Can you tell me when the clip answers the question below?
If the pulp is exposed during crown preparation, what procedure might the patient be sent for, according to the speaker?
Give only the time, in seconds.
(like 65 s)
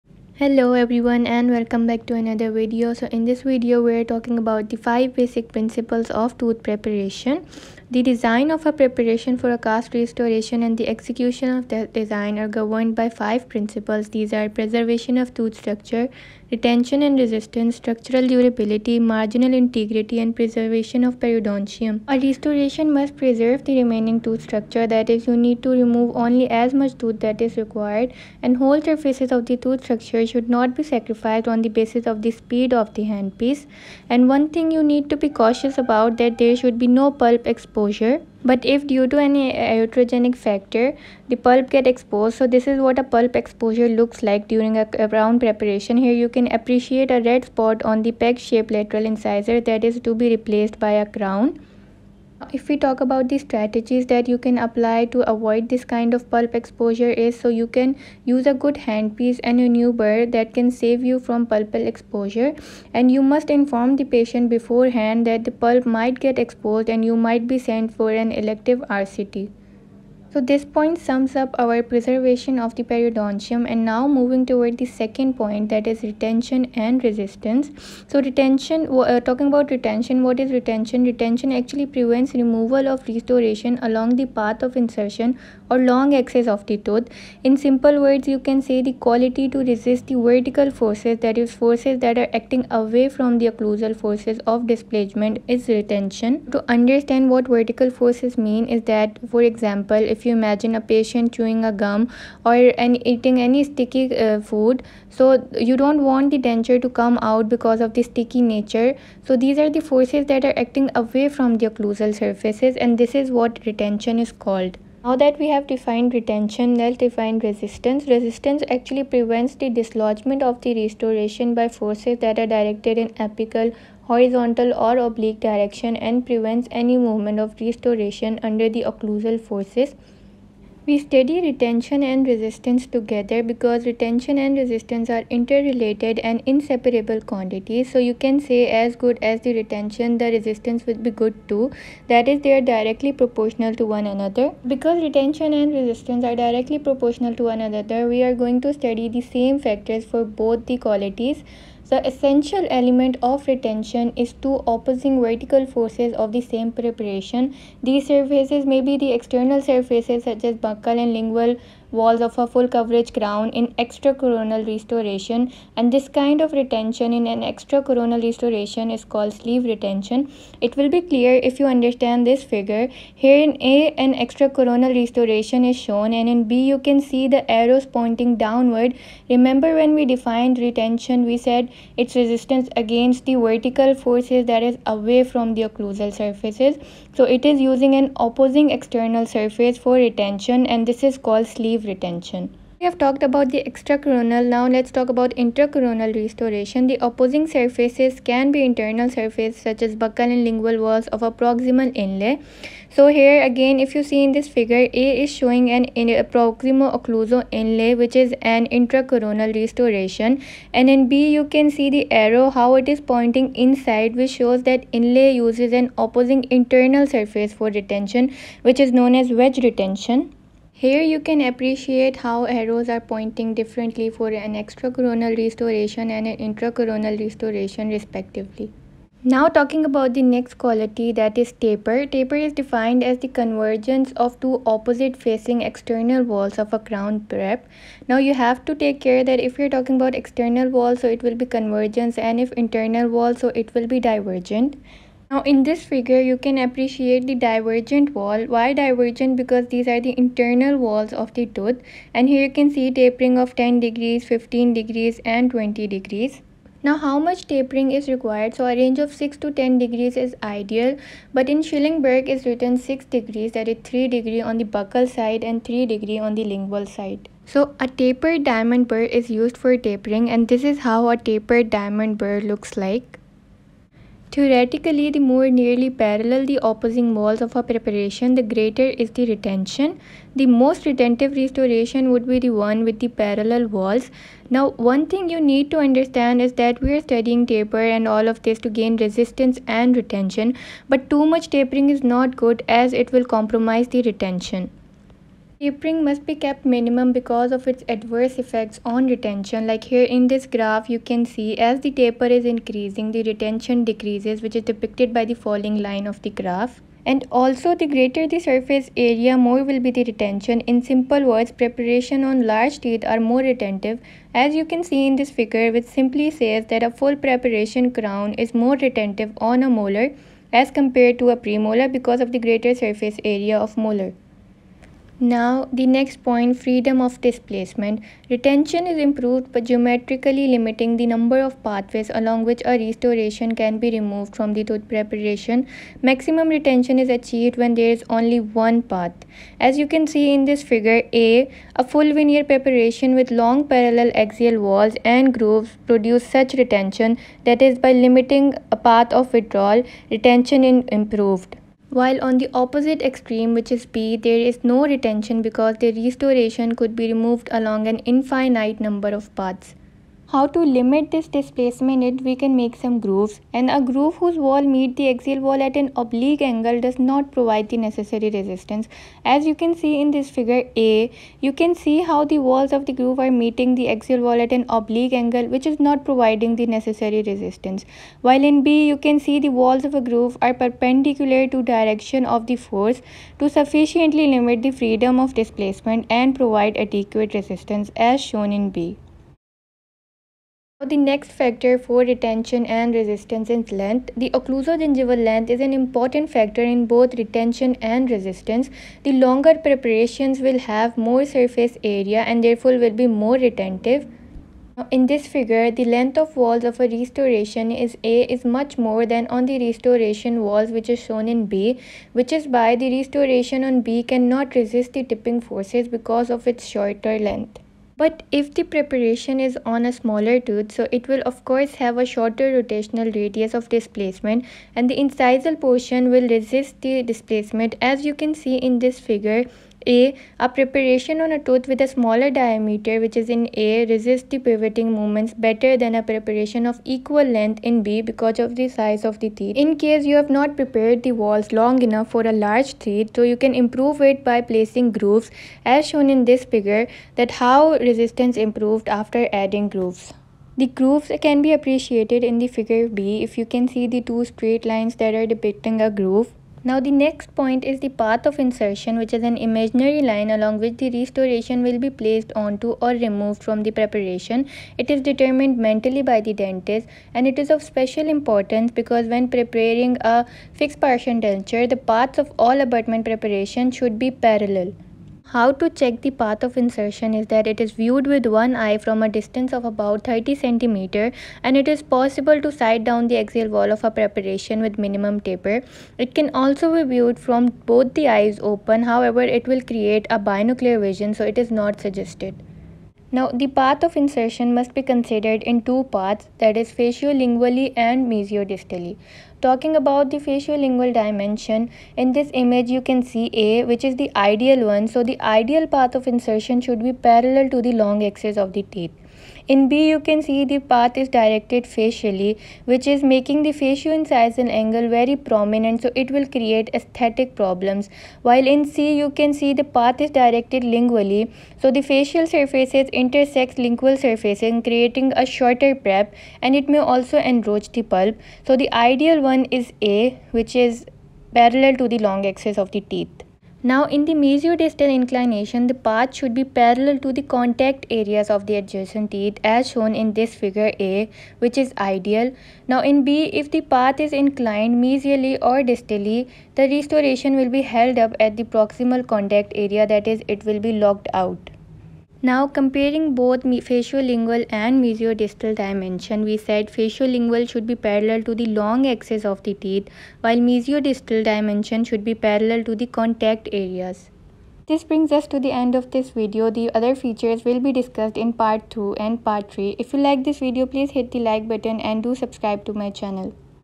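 68 s.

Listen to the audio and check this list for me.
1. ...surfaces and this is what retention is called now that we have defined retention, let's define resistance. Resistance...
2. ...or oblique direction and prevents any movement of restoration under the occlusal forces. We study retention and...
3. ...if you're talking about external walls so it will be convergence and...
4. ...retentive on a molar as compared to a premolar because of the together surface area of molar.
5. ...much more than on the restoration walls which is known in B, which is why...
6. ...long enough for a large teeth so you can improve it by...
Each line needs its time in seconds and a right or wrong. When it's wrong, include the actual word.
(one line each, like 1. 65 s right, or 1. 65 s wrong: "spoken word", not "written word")
1. 112 s right
2. 124 s right
3. 239 s right
4. 318 s wrong: "greater", not "together"
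5. 408 s wrong: "shown", not "known"
6. 441 s right.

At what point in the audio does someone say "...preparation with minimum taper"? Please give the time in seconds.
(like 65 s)
483 s.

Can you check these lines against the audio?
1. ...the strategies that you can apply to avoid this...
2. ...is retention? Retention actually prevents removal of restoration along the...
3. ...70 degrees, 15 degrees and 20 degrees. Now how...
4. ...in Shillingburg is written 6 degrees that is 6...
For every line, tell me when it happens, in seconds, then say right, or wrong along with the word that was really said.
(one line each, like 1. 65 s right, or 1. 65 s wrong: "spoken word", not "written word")
1. 53 s right
2. 80 s right
3. 253 s wrong: "10", not "70"
4. 261 s wrong: "3", not "6".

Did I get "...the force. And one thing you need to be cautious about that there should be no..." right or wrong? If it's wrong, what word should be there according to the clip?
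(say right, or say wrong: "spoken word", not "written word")
wrong: "handpiece", not "force".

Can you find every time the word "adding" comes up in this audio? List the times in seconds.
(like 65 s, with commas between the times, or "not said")
449 s.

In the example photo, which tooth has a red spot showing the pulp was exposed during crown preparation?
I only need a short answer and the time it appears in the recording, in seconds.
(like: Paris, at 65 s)
peg shaped lateral incisor, at 48 s.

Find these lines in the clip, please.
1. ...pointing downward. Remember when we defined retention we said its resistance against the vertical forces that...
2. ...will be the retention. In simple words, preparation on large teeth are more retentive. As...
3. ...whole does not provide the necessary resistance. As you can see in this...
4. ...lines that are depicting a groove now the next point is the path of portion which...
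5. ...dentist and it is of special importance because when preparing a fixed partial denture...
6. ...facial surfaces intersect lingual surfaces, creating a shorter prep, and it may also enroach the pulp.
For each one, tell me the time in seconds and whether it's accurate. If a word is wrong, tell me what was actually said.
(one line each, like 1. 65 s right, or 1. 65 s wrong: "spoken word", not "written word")
1. 177 s right
2. 309 s right
3. 366 s wrong: "angle", not "whole"
4. 454 s wrong: "insertion", not "portion"
5. 466 s right
6. 521 s right.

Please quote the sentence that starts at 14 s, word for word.
These are preservation of tooth structure, retention and resistance, structural durability, marginal integrity, and preservation of periodontium.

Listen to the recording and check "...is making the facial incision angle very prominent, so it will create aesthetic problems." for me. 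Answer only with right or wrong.
right.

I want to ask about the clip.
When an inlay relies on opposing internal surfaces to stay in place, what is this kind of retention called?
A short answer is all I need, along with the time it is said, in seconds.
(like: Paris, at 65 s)
wedge retention, at 219 s.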